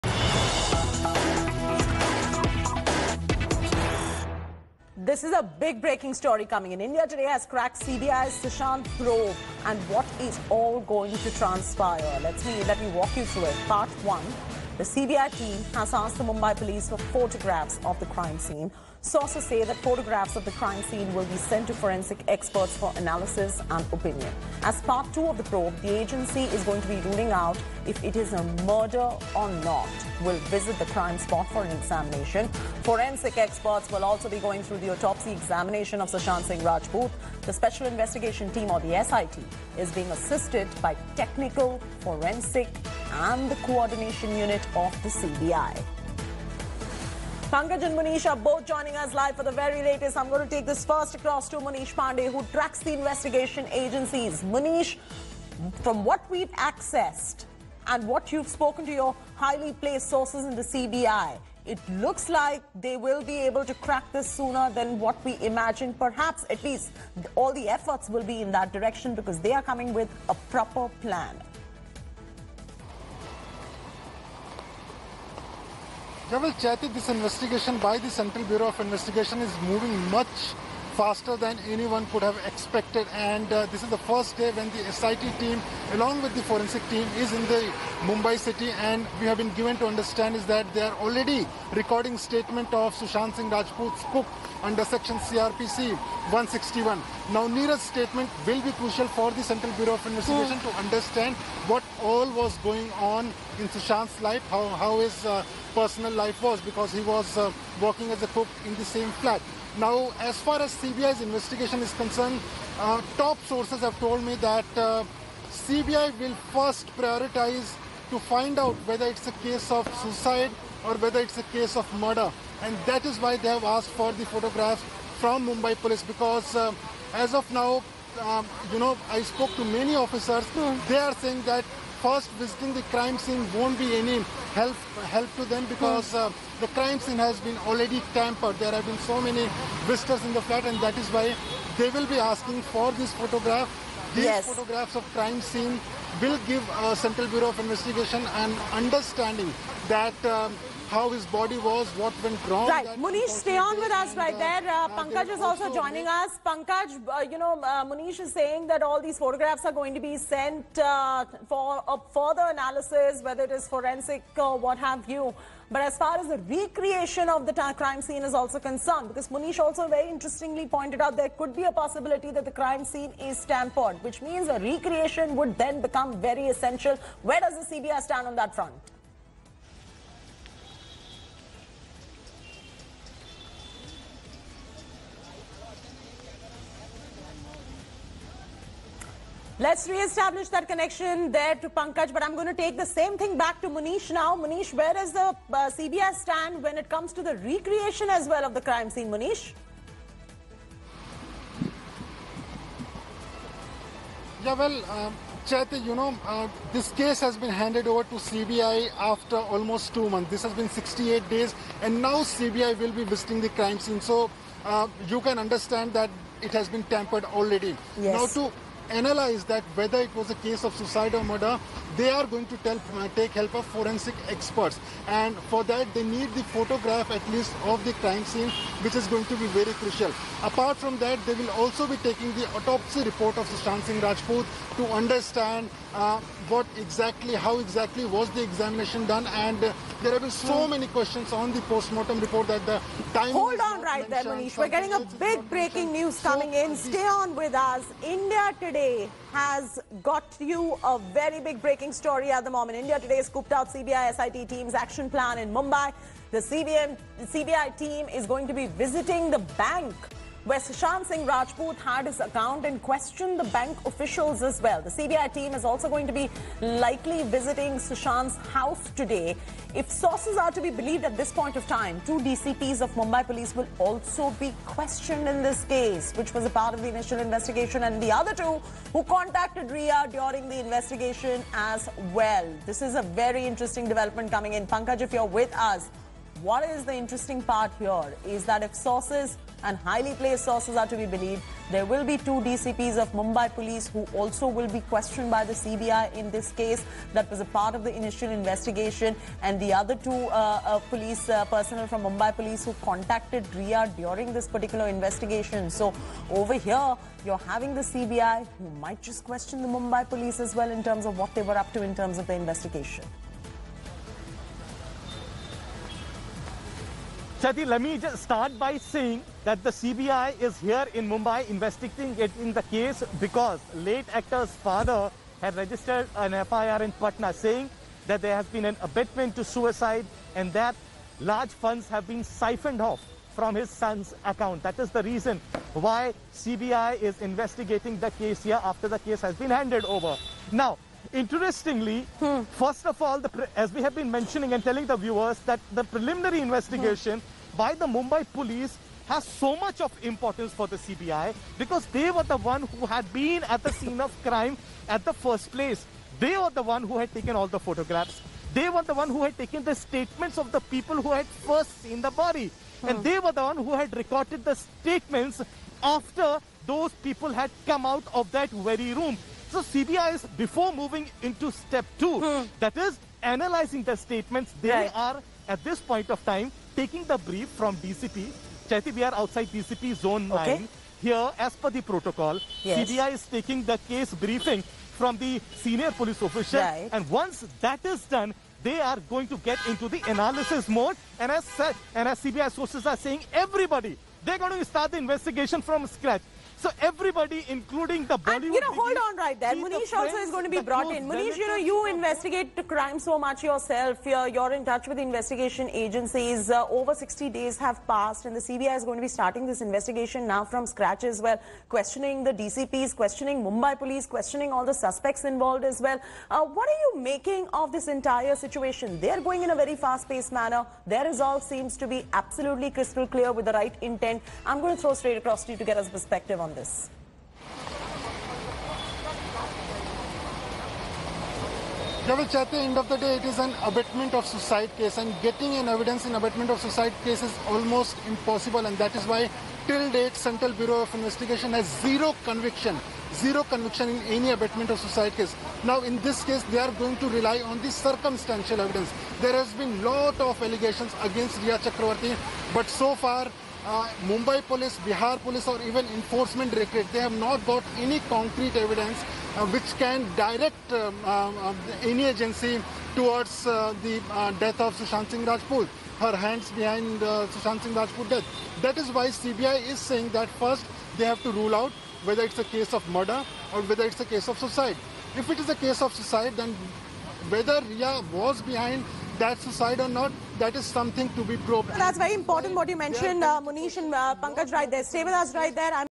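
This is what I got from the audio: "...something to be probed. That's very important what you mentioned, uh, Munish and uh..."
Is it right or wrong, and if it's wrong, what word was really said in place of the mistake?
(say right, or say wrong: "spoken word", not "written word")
right.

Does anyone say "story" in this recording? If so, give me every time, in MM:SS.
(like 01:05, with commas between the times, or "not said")
00:06, 04:11.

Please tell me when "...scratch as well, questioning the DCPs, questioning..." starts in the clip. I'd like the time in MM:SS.
06:50.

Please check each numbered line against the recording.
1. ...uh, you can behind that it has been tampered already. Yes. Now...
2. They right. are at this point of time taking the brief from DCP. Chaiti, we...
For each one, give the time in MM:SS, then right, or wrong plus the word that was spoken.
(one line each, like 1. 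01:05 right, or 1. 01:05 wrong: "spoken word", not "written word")
1. 03:34 wrong: "understand", not "behind"
2. 06:14 right.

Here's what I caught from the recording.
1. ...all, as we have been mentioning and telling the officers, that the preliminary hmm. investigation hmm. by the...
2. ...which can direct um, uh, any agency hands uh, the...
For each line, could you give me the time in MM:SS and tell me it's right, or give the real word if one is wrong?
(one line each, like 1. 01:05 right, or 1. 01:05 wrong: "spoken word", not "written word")
1. 05:43 wrong: "viewers", not "officers"
2. 07:39 wrong: "towards", not "hands".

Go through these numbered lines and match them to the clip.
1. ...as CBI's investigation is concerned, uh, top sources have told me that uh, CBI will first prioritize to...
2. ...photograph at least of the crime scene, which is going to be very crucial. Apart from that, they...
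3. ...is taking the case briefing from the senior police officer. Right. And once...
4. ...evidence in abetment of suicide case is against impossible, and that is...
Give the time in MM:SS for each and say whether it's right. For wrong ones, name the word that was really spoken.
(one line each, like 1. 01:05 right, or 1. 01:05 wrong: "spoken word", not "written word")
1. 01:50 right
2. 03:46 right
3. 06:23 right
4. 07:15 wrong: "almost", not "against".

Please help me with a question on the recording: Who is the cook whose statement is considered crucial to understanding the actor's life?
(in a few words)
Nira.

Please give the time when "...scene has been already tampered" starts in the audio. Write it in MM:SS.
02:17.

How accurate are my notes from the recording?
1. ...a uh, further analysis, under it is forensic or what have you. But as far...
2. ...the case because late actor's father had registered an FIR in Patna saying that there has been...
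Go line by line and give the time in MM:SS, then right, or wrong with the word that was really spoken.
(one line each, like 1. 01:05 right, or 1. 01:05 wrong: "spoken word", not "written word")
1. 02:41 wrong: "whether", not "under"
2. 05:22 right.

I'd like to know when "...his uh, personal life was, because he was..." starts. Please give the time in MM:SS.
01:44.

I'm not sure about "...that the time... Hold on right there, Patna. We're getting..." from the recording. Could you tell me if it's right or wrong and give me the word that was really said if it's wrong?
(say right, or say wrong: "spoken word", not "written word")
wrong: "Manish", not "Patna".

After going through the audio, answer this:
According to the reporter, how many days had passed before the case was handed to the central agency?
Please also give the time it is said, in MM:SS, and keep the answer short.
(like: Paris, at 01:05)
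68, at 03:30.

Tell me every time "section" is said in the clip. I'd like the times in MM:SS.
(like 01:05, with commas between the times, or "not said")
01:34.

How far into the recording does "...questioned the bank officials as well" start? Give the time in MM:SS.
04:22.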